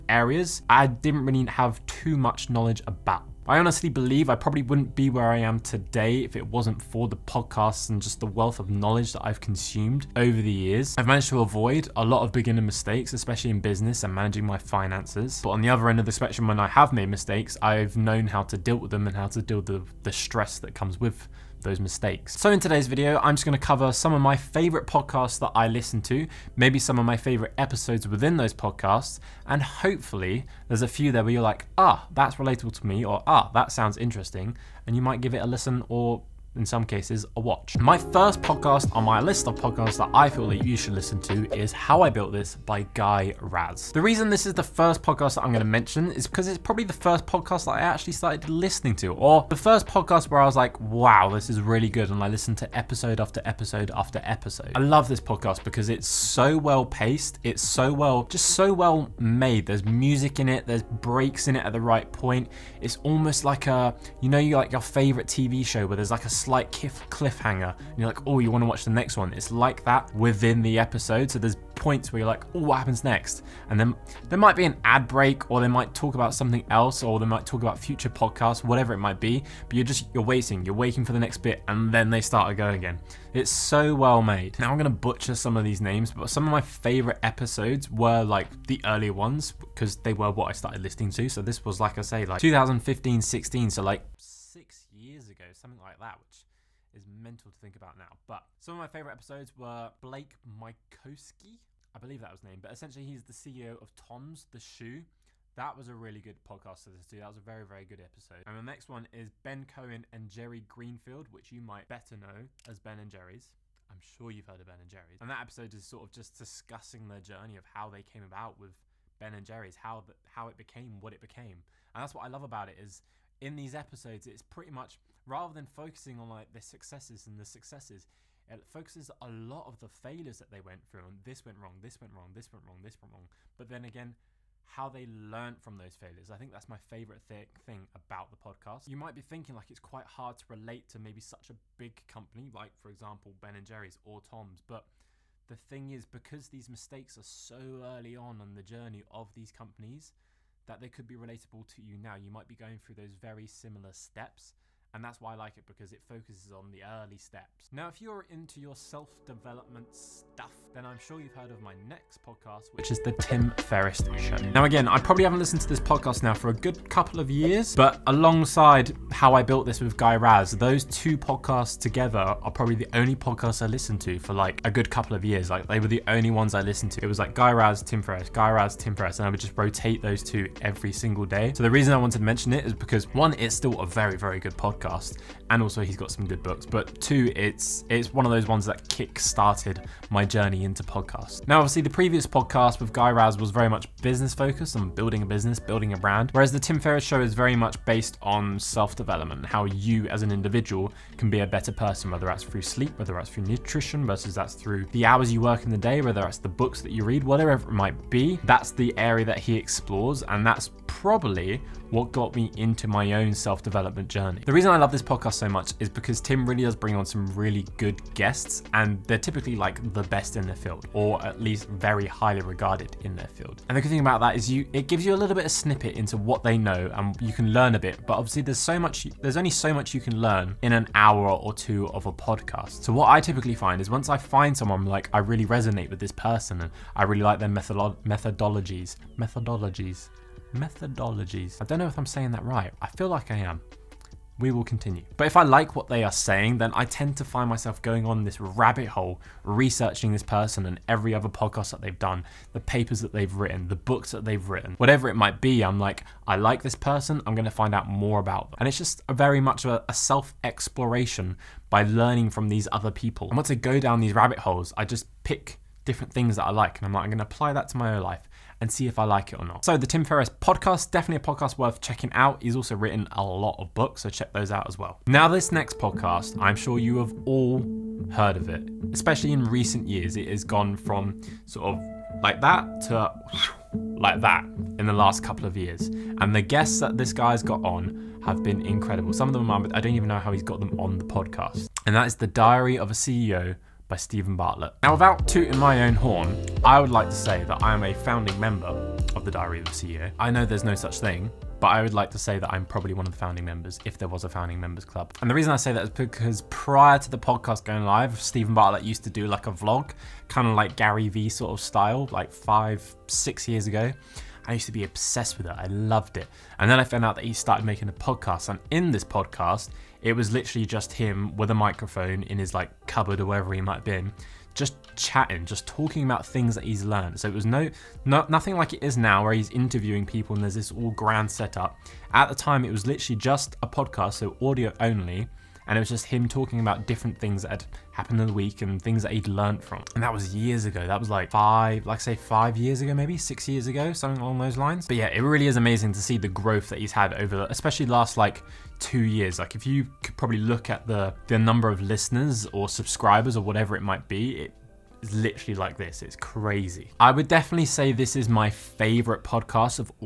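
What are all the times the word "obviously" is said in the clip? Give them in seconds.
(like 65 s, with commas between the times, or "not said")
191 s, 228 s.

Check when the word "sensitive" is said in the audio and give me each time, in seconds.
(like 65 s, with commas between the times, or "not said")
not said.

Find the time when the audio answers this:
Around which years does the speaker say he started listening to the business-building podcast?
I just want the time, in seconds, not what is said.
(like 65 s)
92 s.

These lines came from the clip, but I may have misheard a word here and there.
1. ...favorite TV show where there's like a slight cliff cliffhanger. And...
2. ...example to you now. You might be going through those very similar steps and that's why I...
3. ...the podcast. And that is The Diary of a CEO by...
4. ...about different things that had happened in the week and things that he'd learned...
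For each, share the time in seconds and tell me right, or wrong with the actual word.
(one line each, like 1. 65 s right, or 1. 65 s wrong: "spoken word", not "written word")
1. 64 s right
2. 151 s wrong: "relatable", not "example"
3. 290 s right
4. 336 s right.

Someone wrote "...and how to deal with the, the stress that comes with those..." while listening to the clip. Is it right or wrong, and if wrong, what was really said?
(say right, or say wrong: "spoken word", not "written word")
right.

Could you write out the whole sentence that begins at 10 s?
I've managed to avoid a lot of beginner mistakes, especially in business and managing my finances.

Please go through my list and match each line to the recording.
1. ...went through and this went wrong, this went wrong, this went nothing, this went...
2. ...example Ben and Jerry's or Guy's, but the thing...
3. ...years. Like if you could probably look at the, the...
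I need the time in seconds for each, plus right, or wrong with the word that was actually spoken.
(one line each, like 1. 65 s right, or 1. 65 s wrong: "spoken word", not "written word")
1. 130 s wrong: "wrong", not "nothing"
2. 142 s wrong: "Tom", not "Guy"
3. 349 s right.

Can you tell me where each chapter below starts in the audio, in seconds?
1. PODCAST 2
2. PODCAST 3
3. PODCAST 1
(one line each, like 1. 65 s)
1. 163 s
2. 289 s
3. 38 s.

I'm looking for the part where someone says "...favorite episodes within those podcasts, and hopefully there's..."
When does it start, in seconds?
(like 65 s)
27 s.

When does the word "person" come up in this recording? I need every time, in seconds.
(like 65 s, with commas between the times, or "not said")
201 s, 236 s, 250 s, 256 s.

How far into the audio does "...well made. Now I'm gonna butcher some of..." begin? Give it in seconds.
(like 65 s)
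83 s.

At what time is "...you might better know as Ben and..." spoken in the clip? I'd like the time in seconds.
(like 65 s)
111 s.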